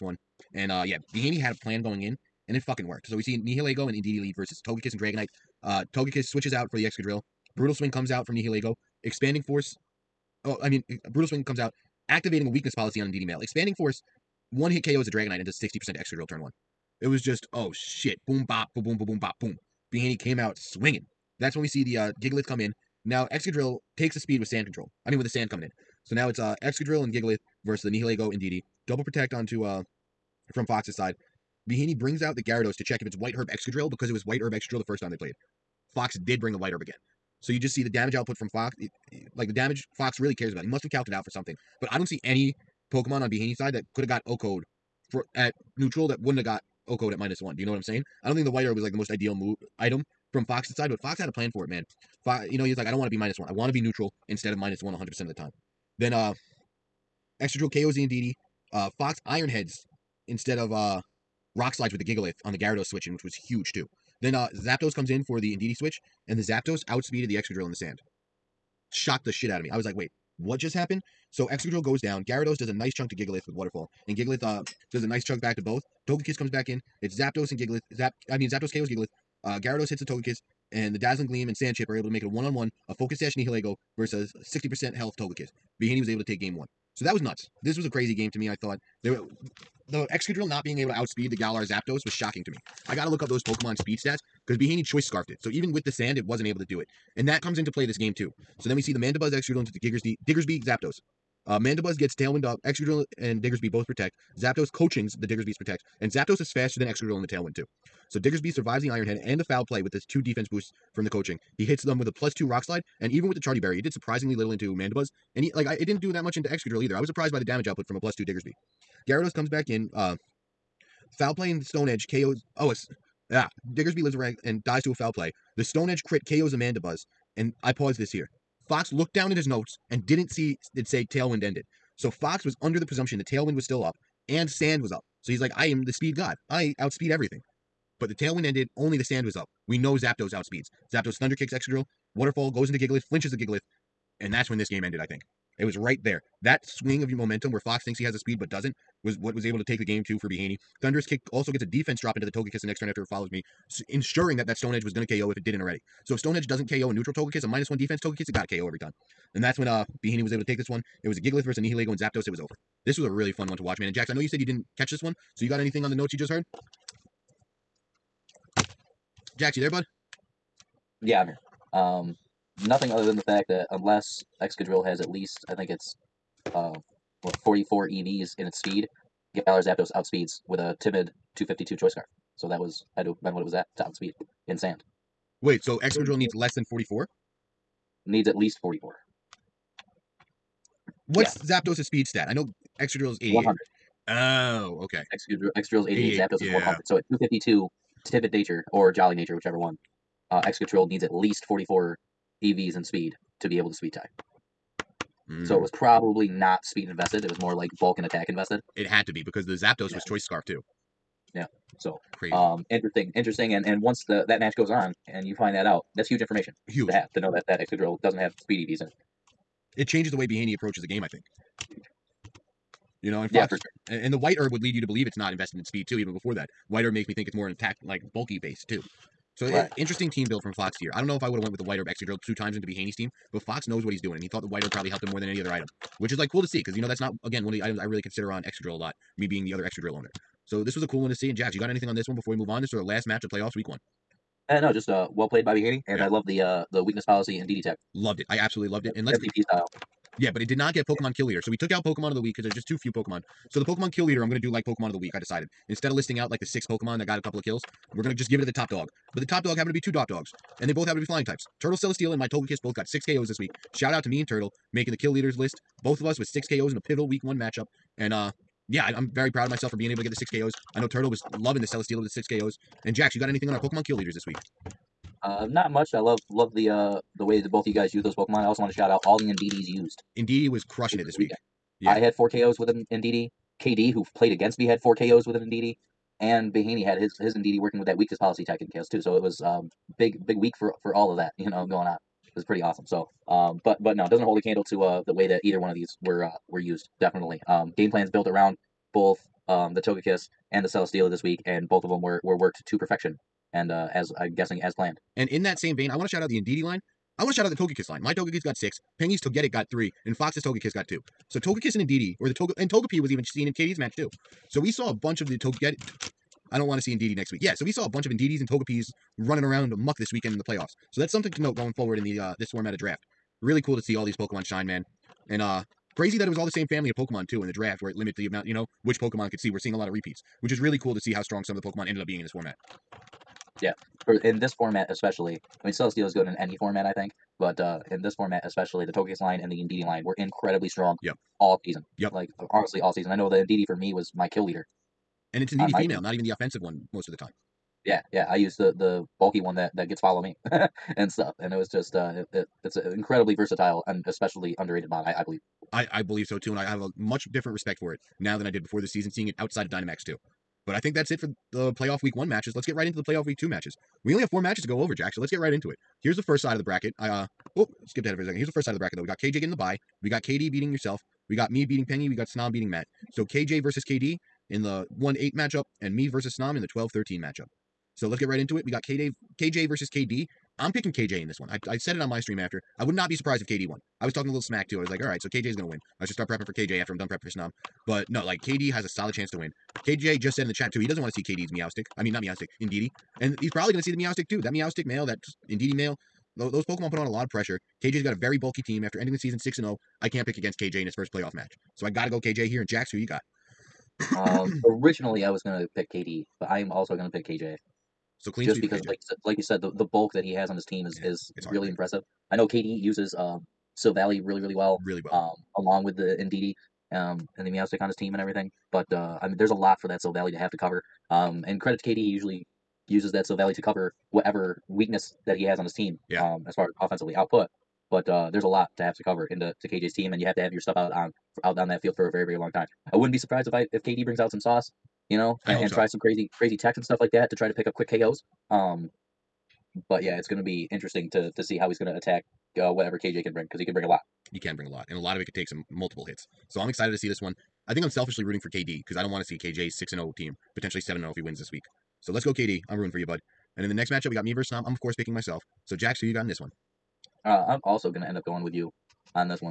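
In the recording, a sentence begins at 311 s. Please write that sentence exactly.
So Togekiss and Indeedee, or the Toga, and Togepi was even seen in KD's match too.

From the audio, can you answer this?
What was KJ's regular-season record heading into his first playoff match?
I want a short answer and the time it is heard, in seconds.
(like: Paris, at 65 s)
6 and 0, at 399 s.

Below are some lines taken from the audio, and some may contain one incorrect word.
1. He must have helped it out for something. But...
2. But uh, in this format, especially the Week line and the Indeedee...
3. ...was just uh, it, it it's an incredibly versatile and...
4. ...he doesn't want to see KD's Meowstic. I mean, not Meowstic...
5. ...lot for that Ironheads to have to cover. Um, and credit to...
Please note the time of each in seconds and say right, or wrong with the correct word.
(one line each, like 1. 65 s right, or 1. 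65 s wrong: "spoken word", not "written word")
1. 40 s wrong: "calced", not "helped"
2. 337 s wrong: "Togekiss", not "Week"
3. 351 s right
4. 390 s right
5. 419 s wrong: "Silvally", not "Ironheads".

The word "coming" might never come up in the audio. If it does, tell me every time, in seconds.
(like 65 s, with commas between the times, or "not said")
25 s.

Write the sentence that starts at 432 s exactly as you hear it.
I wouldn't be surprised if I if KD brings out some sauce, you know, and, and so.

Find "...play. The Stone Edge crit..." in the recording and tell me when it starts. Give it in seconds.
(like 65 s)
125 s.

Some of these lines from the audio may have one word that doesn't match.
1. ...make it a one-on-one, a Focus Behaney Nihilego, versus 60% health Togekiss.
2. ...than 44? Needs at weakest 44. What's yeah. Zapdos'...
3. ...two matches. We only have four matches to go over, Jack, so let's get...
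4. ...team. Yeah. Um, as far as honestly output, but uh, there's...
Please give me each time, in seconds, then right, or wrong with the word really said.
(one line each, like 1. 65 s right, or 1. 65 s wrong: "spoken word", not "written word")
1. 82 s wrong: "Sash", not "Behaney"
2. 186 s wrong: "least", not "weakest"
3. 363 s right
4. 425 s wrong: "offensively", not "honestly".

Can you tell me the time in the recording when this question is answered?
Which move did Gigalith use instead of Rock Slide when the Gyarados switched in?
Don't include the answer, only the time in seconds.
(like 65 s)
59 s.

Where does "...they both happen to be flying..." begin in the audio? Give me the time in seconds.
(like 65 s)
260 s.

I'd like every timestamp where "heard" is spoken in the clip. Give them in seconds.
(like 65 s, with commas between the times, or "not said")
166 s.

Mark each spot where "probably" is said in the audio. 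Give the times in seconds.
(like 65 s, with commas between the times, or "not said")
205 s, 234 s, 393 s.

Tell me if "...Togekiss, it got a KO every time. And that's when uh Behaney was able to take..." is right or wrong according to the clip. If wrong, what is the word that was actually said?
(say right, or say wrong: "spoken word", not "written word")
right.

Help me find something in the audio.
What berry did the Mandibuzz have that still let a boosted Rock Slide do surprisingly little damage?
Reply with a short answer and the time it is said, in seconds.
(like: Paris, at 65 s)
Charti Berry, at 113 s.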